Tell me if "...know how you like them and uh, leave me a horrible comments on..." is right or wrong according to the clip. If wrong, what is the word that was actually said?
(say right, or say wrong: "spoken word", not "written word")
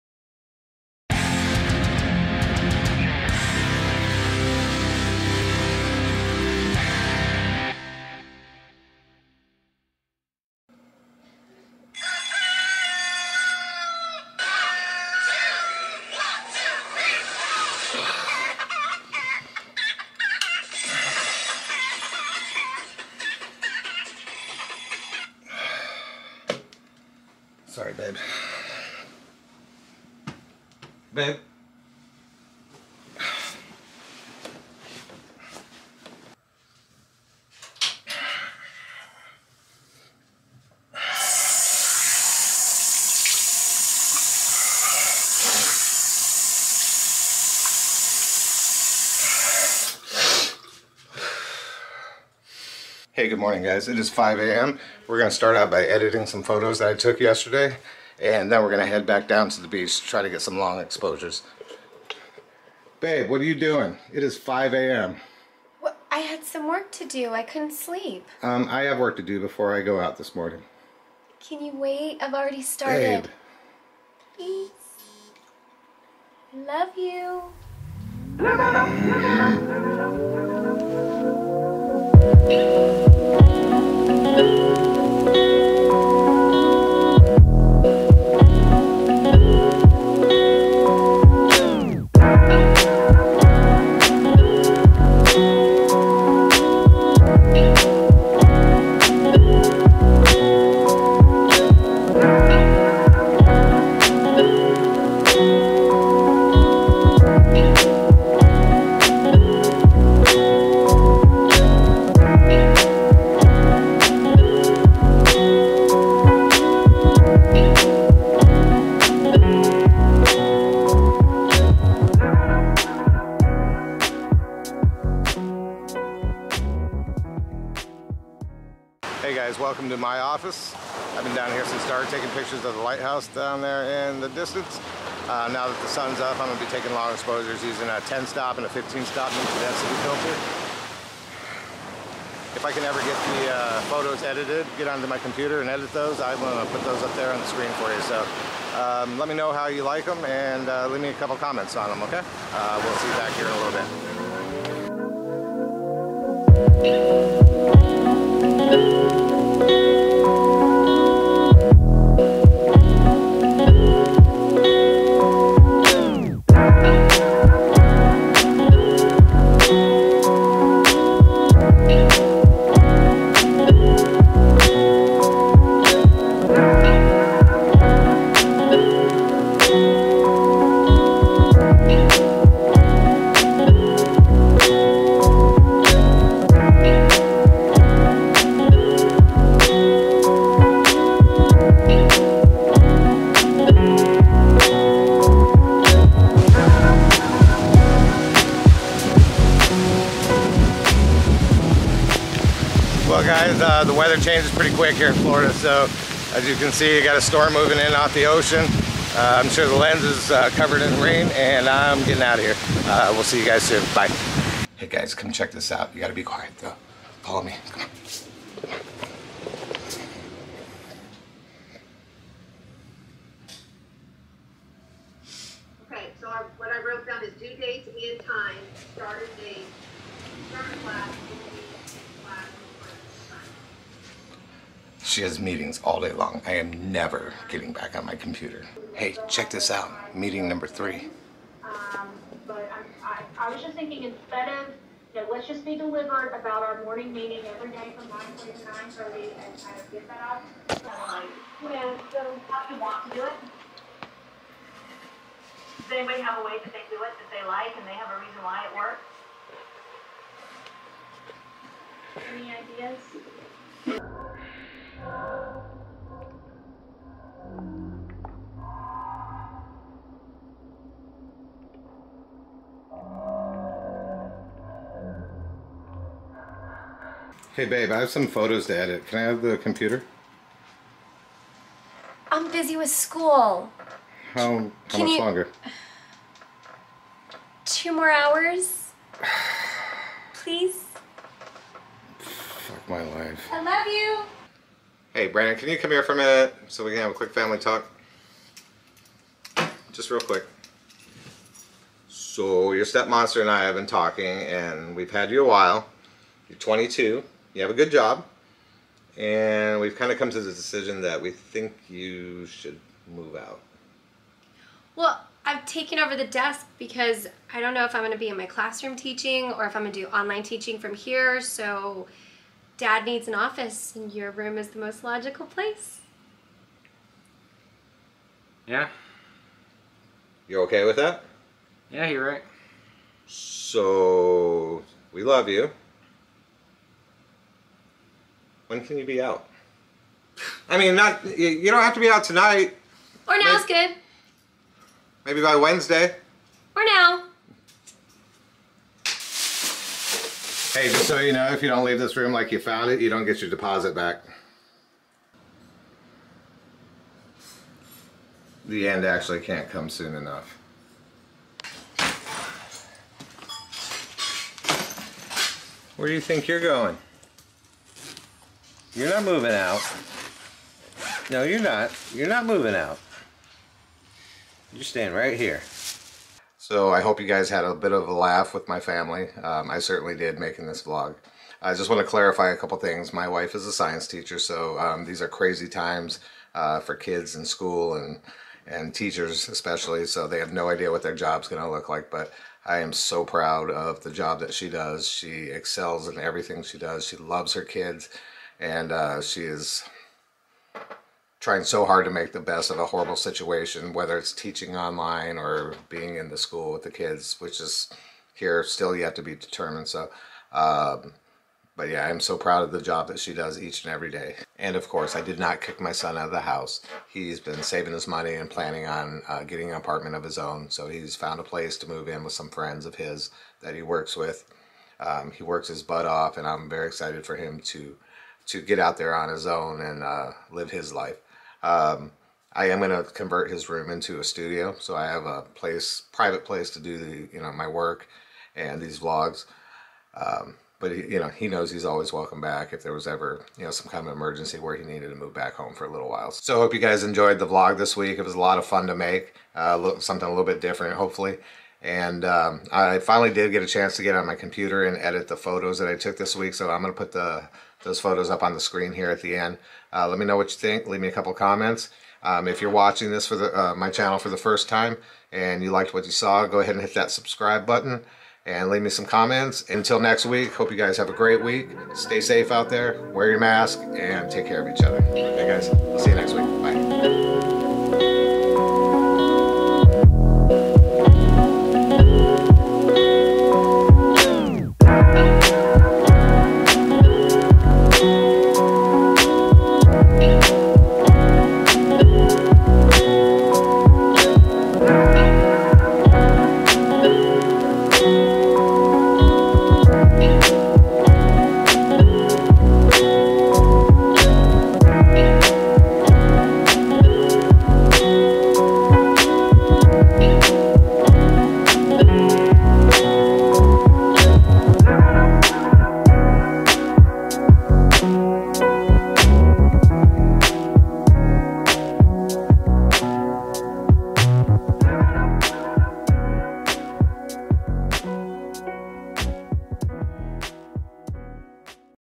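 wrong: "couple", not "horrible".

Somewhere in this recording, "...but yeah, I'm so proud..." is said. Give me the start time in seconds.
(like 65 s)
411 s.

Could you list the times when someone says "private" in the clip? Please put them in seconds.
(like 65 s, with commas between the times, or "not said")
436 s.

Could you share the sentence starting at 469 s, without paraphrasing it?
Until next week, hope you guys have a great week.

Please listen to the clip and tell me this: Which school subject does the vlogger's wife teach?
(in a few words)
Science.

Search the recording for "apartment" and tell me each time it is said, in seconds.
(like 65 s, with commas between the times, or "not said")
419 s.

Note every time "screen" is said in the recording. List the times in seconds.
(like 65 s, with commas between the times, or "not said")
147 s, 458 s.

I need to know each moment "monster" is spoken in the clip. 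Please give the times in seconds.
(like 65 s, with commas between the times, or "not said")
303 s.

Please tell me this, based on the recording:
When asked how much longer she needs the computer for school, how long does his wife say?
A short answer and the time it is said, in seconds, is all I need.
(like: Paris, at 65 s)
2 hours, at 287 s.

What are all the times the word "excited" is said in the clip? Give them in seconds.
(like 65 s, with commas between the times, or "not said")
426 s.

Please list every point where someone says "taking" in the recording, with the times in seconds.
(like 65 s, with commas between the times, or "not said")
132 s, 136 s.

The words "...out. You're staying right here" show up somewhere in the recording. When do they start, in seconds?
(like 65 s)
372 s.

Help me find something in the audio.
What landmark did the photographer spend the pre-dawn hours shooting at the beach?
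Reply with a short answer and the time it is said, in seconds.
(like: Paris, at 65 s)
The lighthouse, at 132 s.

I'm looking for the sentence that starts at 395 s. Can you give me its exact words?
She excels in everything she does.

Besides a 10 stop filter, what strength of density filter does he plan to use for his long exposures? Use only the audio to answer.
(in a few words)
15 stop.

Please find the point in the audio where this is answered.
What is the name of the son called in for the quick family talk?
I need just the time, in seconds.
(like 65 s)
295 s.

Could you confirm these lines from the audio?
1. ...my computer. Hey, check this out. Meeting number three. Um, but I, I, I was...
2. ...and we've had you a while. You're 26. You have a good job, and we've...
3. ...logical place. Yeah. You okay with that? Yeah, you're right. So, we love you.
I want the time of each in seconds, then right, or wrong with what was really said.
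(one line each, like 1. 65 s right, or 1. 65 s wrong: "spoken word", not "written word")
1. 238 s right
2. 304 s wrong: "22", not "26"
3. 325 s right.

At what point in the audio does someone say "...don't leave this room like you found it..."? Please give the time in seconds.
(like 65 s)
351 s.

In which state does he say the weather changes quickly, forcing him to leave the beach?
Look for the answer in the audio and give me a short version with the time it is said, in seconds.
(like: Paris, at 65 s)
Florida, at 205 s.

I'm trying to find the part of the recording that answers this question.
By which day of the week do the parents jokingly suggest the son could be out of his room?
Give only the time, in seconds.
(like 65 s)
345 s.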